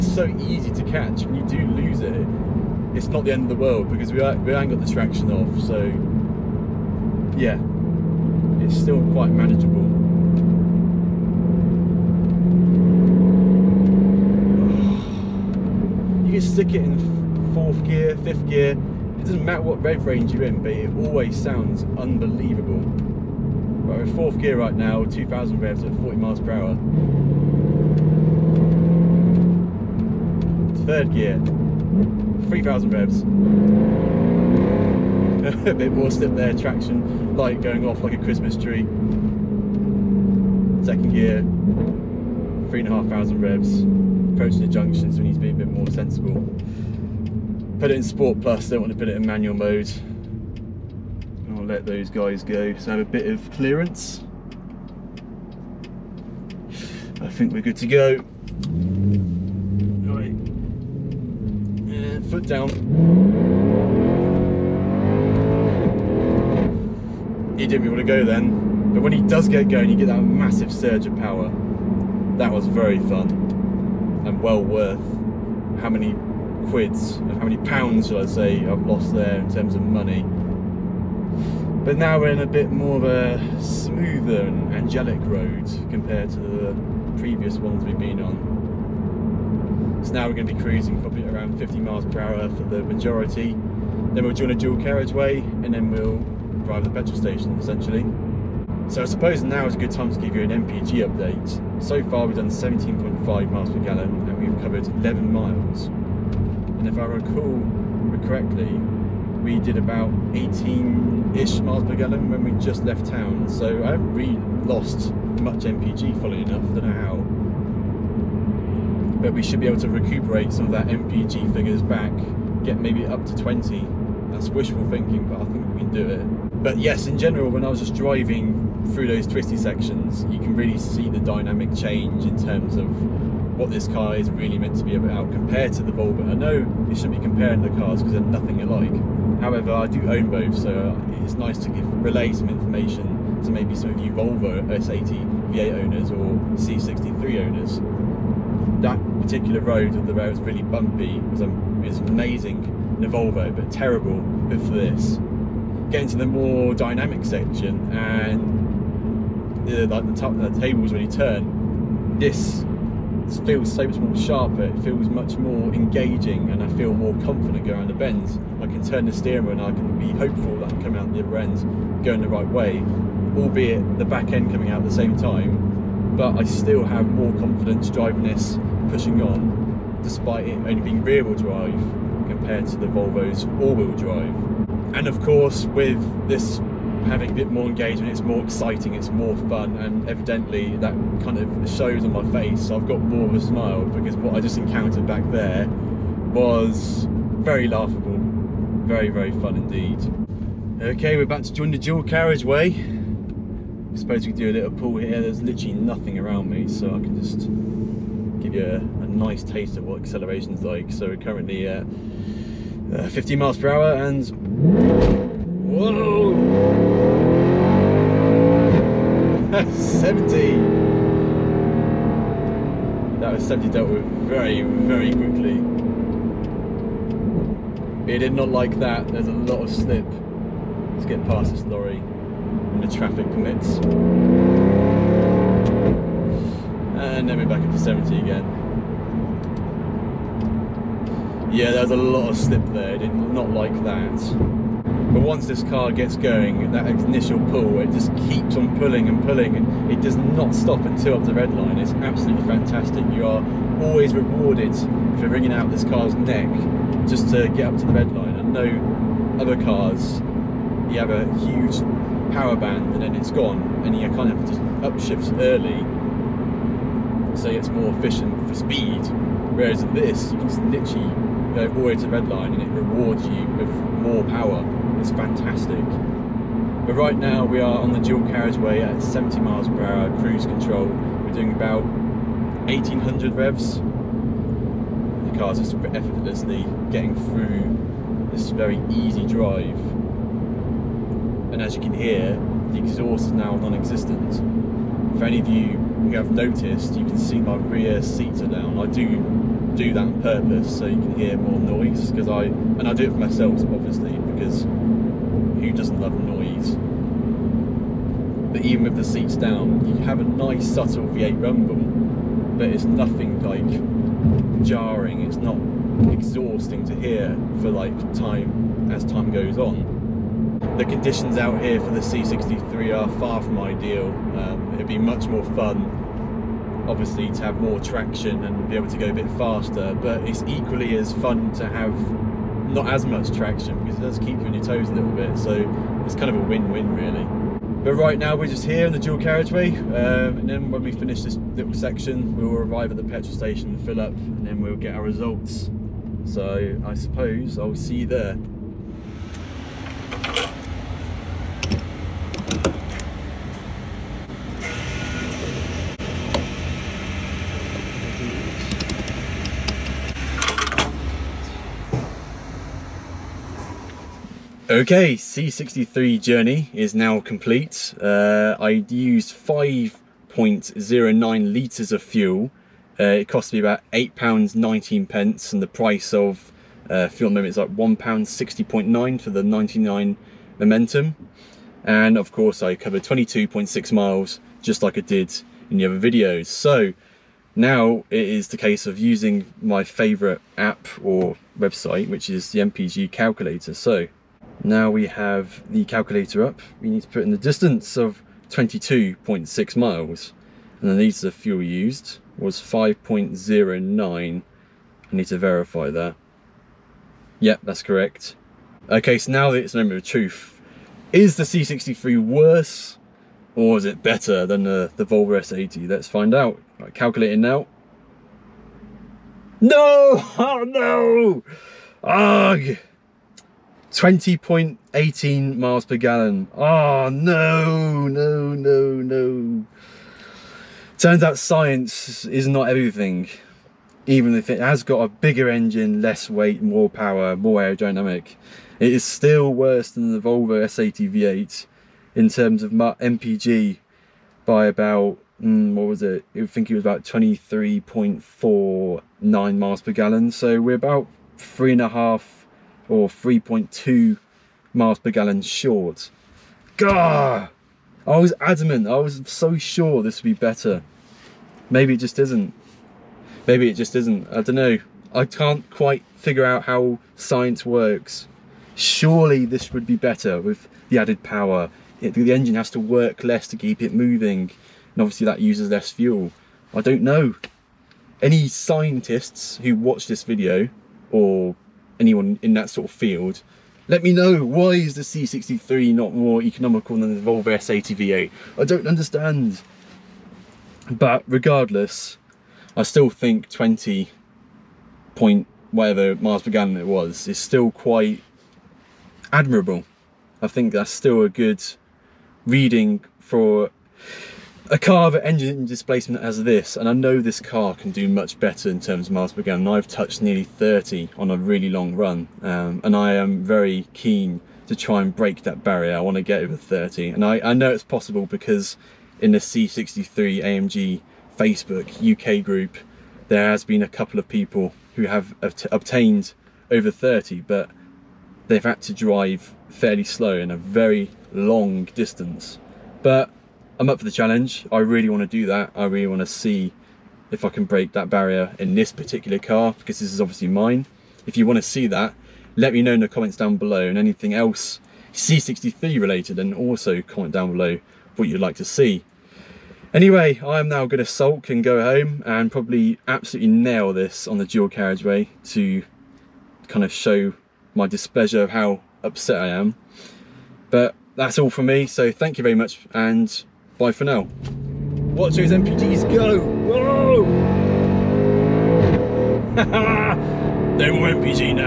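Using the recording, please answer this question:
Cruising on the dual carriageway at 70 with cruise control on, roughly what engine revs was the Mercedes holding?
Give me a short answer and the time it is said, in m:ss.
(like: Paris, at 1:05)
1800, at 4:42.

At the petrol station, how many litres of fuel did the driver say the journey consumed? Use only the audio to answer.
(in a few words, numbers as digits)
5.09 litres.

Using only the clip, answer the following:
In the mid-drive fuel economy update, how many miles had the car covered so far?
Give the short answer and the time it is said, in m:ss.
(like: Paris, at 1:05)
11 miles, at 1:44.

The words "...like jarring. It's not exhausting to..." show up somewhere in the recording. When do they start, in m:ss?
5:13.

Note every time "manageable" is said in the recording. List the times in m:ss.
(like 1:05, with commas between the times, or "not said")
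0:09.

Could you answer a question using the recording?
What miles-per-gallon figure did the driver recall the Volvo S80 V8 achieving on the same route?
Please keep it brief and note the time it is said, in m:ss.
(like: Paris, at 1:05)
23.49, at 7:27.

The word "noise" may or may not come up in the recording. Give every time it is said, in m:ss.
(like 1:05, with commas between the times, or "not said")
5:01, 5:06.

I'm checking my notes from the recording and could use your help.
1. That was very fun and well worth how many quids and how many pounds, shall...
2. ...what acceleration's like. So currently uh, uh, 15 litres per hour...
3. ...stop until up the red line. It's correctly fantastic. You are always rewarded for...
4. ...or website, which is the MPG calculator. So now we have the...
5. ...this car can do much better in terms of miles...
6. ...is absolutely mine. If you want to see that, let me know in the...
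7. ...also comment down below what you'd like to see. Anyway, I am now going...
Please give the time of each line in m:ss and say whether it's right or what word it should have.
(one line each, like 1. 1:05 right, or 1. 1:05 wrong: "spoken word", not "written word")
1. 1:12 right
2. 3:29 wrong: "miles", not "litres"
3. 4:10 wrong: "absolutely", not "correctly"
4. 6:31 right
5. 8:27 right
6. 9:00 wrong: "obviously", not "absolutely"
7. 9:06 right.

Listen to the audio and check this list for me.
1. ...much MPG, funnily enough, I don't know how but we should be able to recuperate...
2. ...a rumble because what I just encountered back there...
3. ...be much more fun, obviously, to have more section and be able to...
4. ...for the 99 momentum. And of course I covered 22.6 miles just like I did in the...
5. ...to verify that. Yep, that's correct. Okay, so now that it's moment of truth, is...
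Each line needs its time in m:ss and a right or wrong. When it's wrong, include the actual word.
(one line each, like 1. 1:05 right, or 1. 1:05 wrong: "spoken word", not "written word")
1. 1:55 right
2. 3:13 wrong: "smile", not "rumble"
3. 5:24 wrong: "traction", not "section"
4. 6:19 right
5. 6:45 right.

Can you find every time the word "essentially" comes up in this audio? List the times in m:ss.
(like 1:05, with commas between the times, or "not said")
1:37.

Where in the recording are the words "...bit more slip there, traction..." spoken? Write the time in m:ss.
0:35.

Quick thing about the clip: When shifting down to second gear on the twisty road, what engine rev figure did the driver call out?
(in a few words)
3,500.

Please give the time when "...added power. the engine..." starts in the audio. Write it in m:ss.
7:50.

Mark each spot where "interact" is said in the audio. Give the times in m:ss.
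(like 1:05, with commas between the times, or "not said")
not said.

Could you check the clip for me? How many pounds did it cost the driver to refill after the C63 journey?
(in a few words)
£8.19.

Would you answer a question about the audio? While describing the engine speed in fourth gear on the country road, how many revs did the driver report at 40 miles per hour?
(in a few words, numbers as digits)
2000.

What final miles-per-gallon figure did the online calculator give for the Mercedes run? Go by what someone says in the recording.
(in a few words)
20.18.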